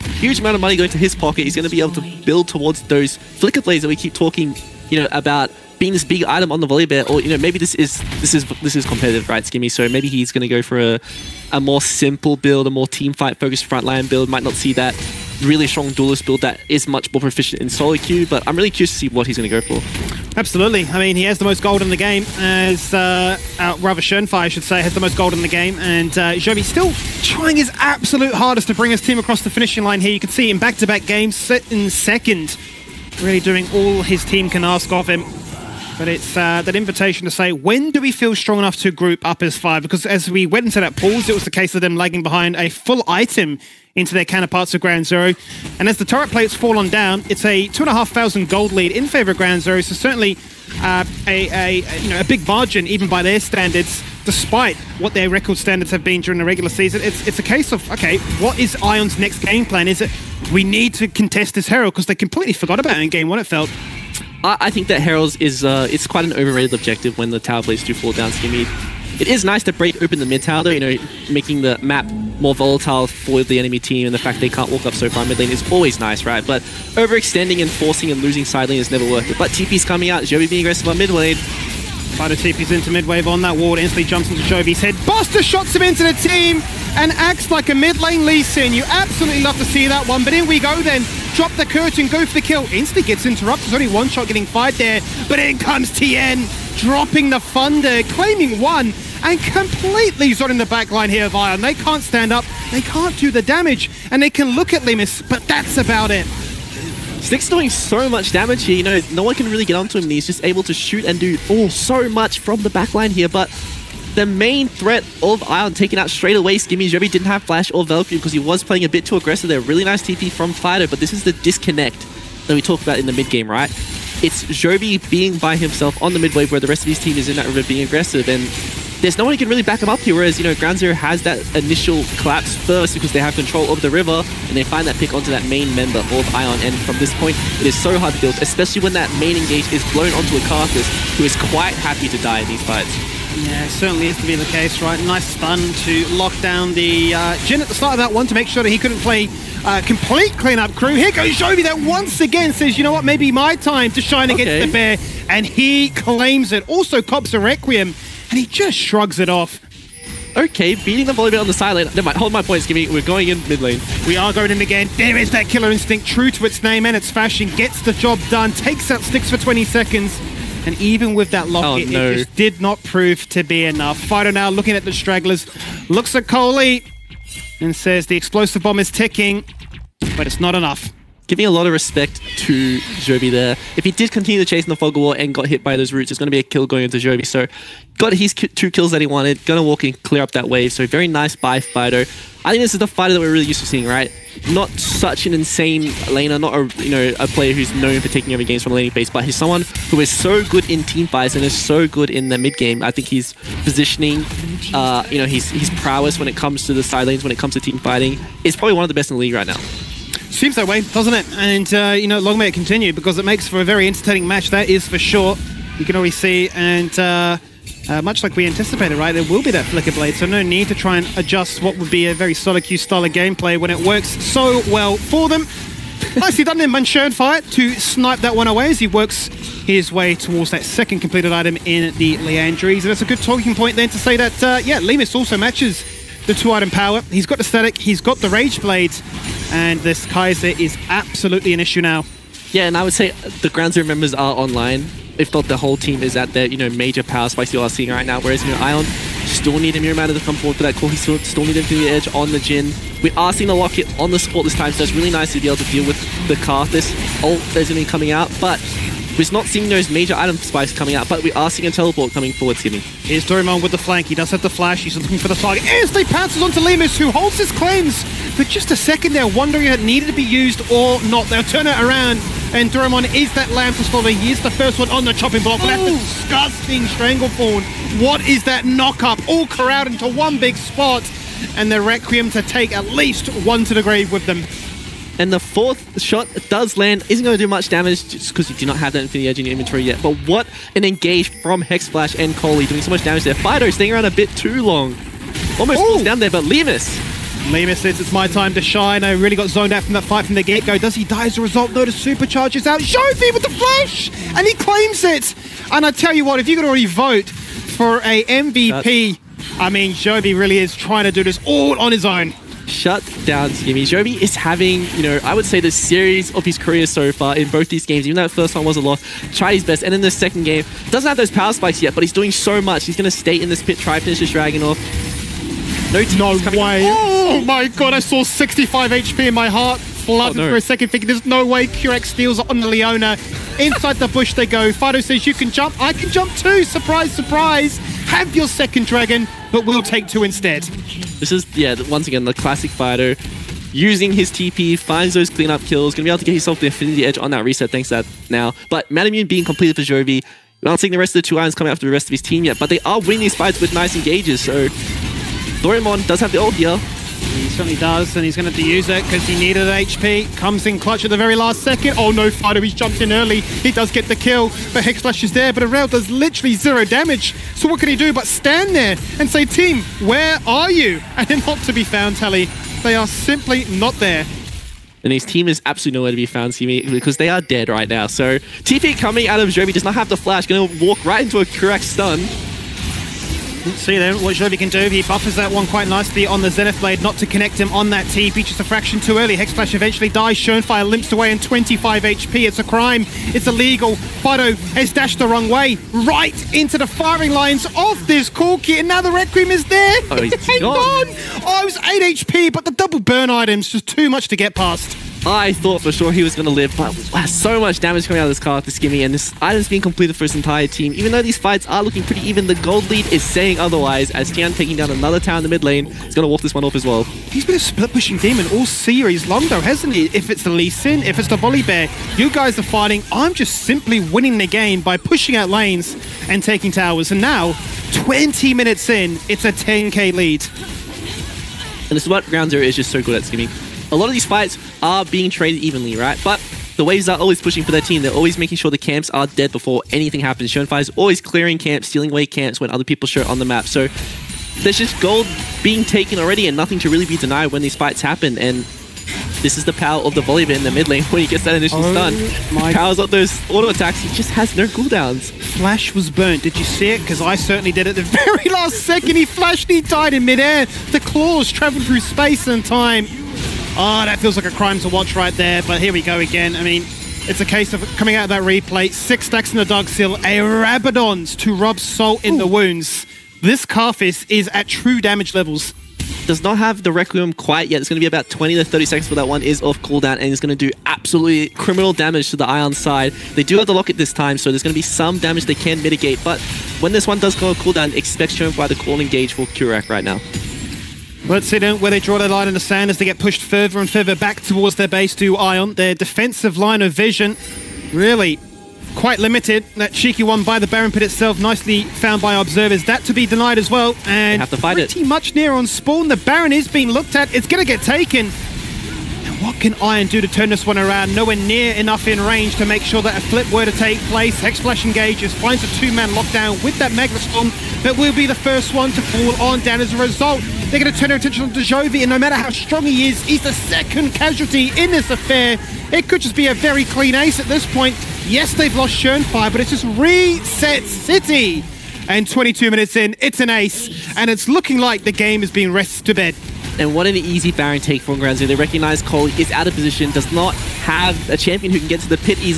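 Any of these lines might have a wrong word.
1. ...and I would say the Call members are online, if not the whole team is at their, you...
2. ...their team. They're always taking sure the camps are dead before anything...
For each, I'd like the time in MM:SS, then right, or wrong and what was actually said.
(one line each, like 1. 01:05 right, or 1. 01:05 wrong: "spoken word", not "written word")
1. 04:02 wrong: "Ground", not "Call"
2. 07:17 wrong: "making", not "taking".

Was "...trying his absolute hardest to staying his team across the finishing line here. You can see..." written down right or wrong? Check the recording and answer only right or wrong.
wrong.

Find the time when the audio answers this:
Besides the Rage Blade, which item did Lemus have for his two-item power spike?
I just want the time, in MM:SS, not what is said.
03:57.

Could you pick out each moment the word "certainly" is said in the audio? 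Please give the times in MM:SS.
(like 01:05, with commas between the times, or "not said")
00:49, 02:23, 05:57, 07:37.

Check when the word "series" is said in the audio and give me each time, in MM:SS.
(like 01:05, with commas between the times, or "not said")
05:15, 06:58.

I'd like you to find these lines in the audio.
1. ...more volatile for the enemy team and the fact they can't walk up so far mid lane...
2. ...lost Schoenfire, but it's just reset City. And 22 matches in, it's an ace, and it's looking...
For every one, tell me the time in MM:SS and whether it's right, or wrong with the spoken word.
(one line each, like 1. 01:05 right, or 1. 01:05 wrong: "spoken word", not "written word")
1. 01:12 right
2. 08:48 wrong: "minutes", not "matches".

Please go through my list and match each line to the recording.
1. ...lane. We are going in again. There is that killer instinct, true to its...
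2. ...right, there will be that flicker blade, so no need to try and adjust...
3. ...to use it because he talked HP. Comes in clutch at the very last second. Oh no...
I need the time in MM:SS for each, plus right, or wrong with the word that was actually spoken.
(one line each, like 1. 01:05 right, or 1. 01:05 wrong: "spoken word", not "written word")
1. 02:43 right
2. 03:38 right
3. 05:58 wrong: "needed", not "talked".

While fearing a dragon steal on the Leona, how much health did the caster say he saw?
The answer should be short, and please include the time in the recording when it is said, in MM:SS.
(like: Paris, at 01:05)
65 HP, at 05:28.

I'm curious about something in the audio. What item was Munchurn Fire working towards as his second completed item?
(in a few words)
Liandry's.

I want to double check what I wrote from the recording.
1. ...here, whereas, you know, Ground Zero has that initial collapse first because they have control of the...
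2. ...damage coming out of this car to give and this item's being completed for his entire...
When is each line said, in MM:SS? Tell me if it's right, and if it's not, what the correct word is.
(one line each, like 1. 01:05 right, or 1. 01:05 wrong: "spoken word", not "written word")
1. 02:09 right
2. 06:47 right.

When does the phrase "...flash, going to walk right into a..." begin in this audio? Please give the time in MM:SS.
06:20.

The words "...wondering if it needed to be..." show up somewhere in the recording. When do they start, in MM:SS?
04:29.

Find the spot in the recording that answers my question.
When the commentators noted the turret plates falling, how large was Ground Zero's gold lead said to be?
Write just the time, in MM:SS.
00:47.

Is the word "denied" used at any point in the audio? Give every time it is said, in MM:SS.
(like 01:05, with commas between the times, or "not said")
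07:27, 08:23.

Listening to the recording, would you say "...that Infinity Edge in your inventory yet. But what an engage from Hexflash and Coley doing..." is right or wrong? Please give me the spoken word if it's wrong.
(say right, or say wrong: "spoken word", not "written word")
right.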